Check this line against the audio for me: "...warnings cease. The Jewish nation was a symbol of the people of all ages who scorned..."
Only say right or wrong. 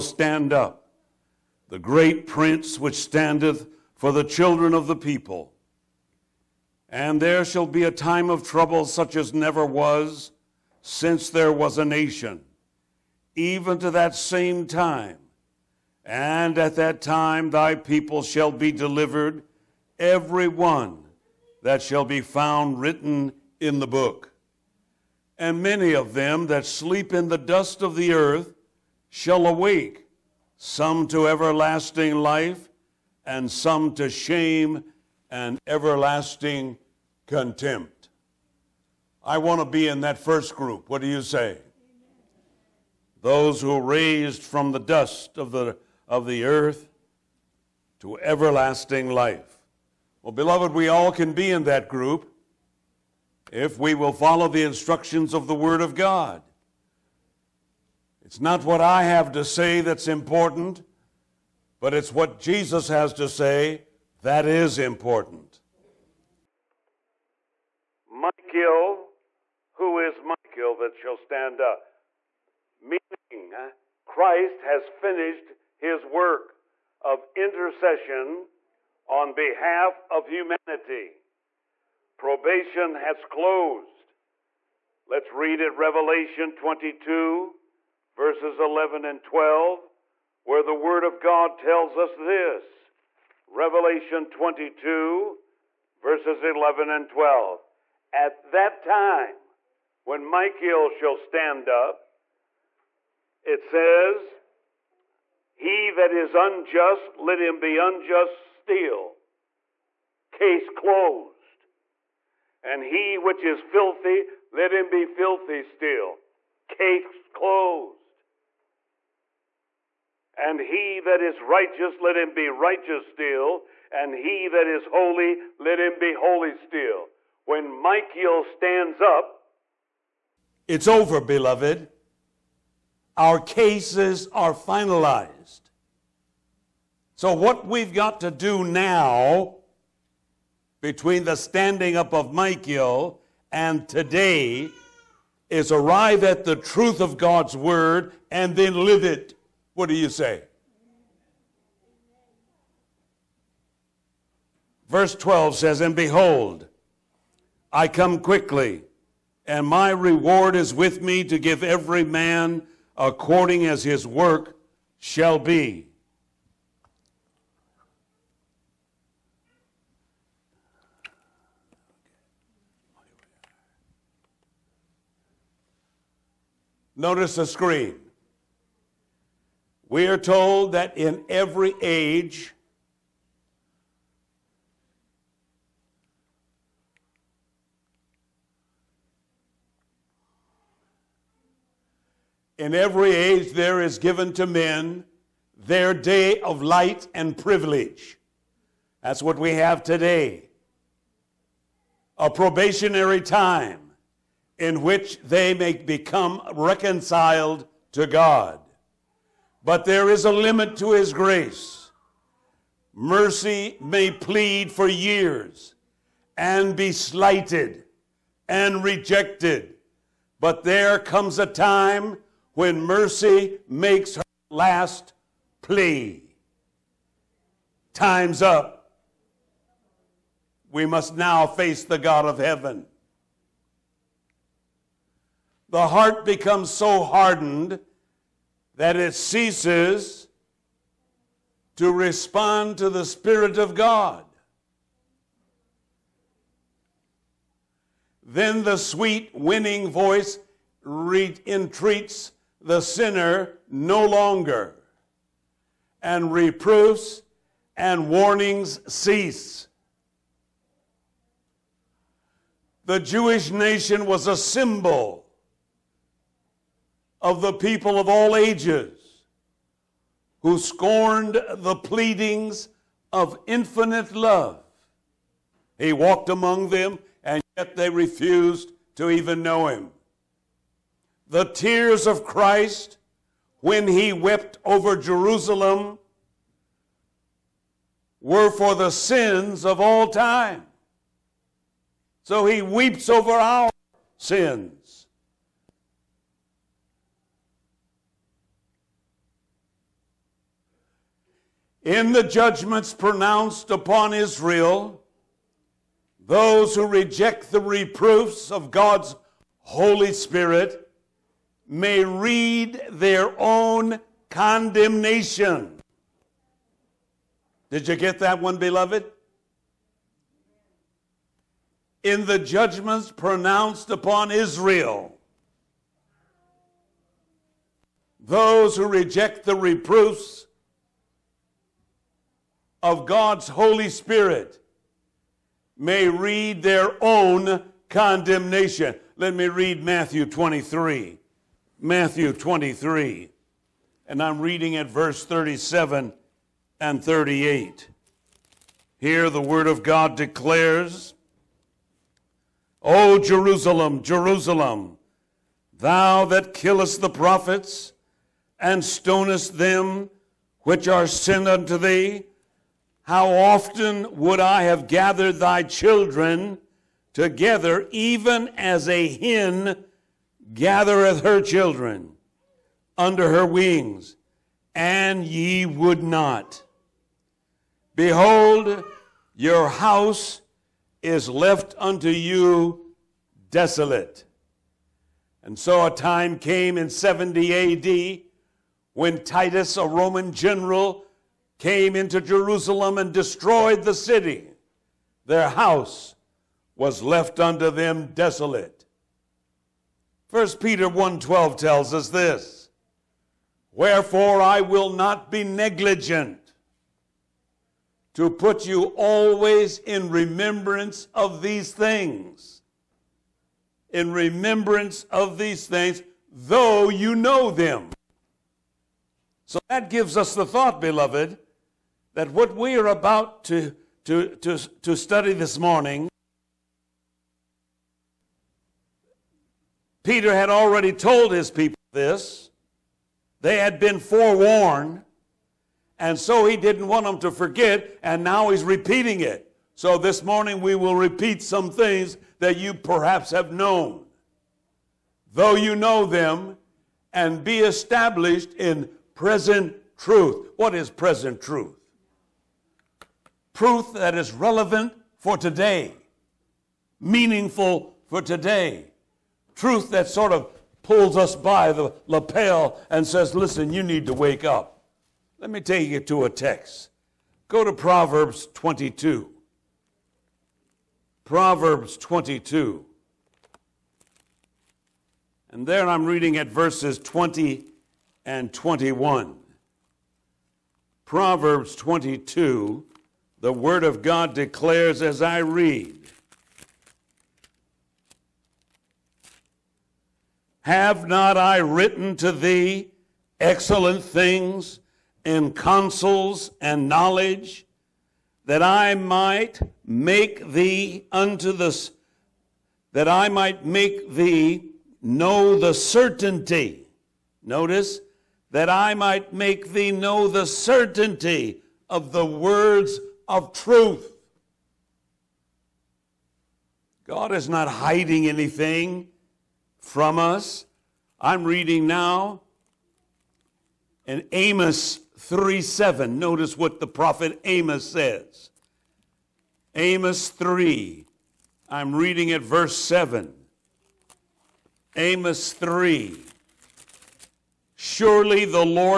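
right.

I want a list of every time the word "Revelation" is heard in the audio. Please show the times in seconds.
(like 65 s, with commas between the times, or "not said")
85 s, 93 s.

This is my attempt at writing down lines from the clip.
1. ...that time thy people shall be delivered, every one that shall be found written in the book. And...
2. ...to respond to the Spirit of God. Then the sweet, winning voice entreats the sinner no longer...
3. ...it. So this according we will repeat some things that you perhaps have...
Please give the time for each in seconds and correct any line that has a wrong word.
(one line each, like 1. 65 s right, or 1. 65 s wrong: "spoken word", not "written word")
1. 16 s right
2. 241 s right
3. 439 s wrong: "morning", not "according".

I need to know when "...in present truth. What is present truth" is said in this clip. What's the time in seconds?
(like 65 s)
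448 s.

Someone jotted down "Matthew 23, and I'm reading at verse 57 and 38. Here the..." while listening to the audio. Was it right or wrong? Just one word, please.
wrong.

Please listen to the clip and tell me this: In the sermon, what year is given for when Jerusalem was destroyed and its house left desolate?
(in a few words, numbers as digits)
70 AD.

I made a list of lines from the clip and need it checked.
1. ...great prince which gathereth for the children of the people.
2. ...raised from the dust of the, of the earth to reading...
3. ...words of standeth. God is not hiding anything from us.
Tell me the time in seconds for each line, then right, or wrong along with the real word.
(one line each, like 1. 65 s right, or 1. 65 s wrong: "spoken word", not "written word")
1. 1 s wrong: "standeth", not "gathereth"
2. 43 s wrong: "everlasting", not "reading"
3. 512 s wrong: "truth", not "standeth".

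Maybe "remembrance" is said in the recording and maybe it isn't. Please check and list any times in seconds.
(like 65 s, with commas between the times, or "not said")
410 s, 414 s.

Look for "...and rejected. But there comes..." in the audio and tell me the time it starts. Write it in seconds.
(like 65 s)
218 s.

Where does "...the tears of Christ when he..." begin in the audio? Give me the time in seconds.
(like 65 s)
281 s.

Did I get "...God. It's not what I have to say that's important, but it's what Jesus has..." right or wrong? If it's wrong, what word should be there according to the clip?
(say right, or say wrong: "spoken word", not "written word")
right.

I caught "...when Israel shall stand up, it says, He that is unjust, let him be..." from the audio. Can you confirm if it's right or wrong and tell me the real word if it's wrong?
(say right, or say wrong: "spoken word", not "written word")
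wrong: "Michael", not "Israel".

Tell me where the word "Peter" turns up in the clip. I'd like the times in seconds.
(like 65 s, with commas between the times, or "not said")
400 s, 430 s.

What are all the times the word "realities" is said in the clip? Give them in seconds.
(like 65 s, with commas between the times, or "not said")
not said.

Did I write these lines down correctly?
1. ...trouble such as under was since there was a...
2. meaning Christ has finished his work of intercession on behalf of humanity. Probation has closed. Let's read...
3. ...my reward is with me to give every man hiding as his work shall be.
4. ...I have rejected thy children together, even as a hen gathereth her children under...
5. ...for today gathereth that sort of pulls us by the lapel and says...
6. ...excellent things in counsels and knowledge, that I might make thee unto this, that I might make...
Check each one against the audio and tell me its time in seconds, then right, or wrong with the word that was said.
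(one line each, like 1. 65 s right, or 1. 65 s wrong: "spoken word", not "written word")
1. 8 s wrong: "never", not "under"
2. 72 s right
3. 159 s wrong: "according", not "hiding"
4. 364 s wrong: "gathered", not "rejected"
5. 458 s wrong: "truth", not "gathereth"
6. 493 s right.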